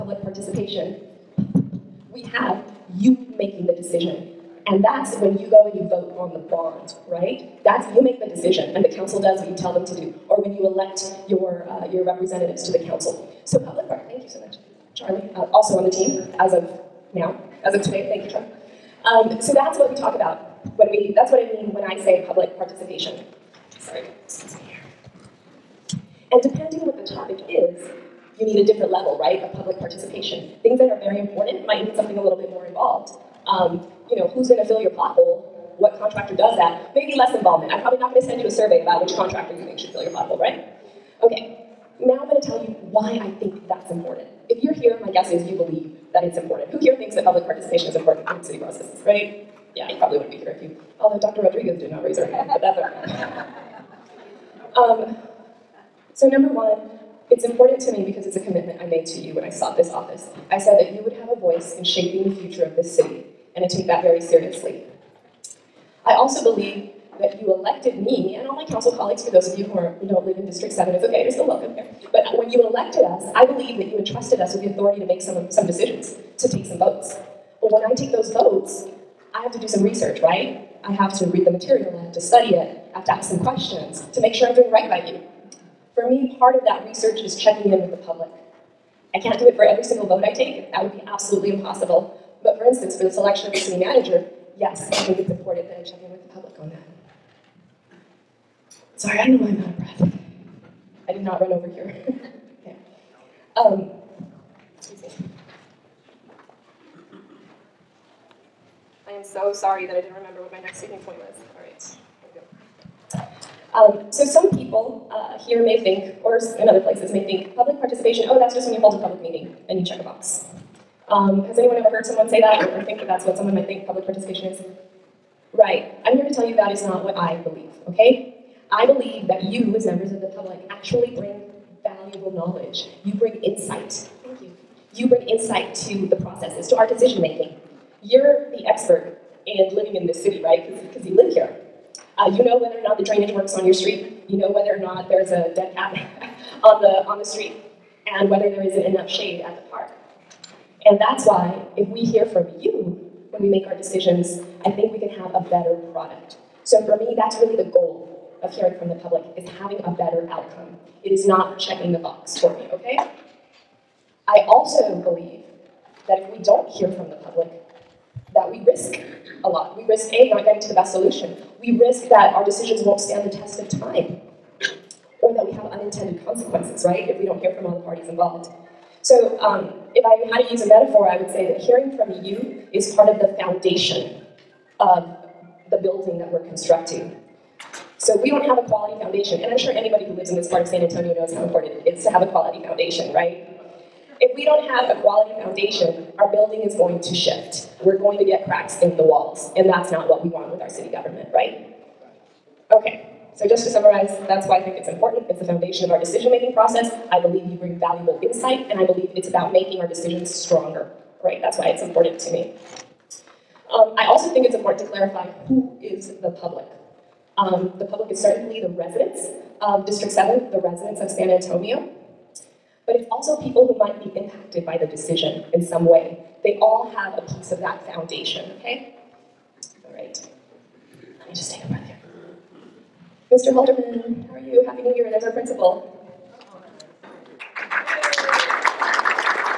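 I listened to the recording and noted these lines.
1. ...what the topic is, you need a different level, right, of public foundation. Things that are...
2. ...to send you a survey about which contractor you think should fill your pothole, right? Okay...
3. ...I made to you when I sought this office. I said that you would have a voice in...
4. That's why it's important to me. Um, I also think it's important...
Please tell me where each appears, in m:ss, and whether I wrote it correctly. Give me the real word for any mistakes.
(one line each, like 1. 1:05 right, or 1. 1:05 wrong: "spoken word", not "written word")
1. 0:26 wrong: "participation", not "foundation"
2. 0:38 right
3. 0:58 right
4. 3:31 right.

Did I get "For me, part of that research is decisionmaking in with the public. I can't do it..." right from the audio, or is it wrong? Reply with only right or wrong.
wrong.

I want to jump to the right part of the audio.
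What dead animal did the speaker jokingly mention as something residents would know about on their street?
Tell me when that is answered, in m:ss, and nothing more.
2:25.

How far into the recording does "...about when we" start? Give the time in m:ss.
0:20.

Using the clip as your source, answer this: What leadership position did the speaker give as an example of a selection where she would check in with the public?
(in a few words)
City manager.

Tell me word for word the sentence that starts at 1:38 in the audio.
Sorry, I don't know why I'm out of breath.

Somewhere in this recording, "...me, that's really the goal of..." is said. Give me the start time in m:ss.
2:36.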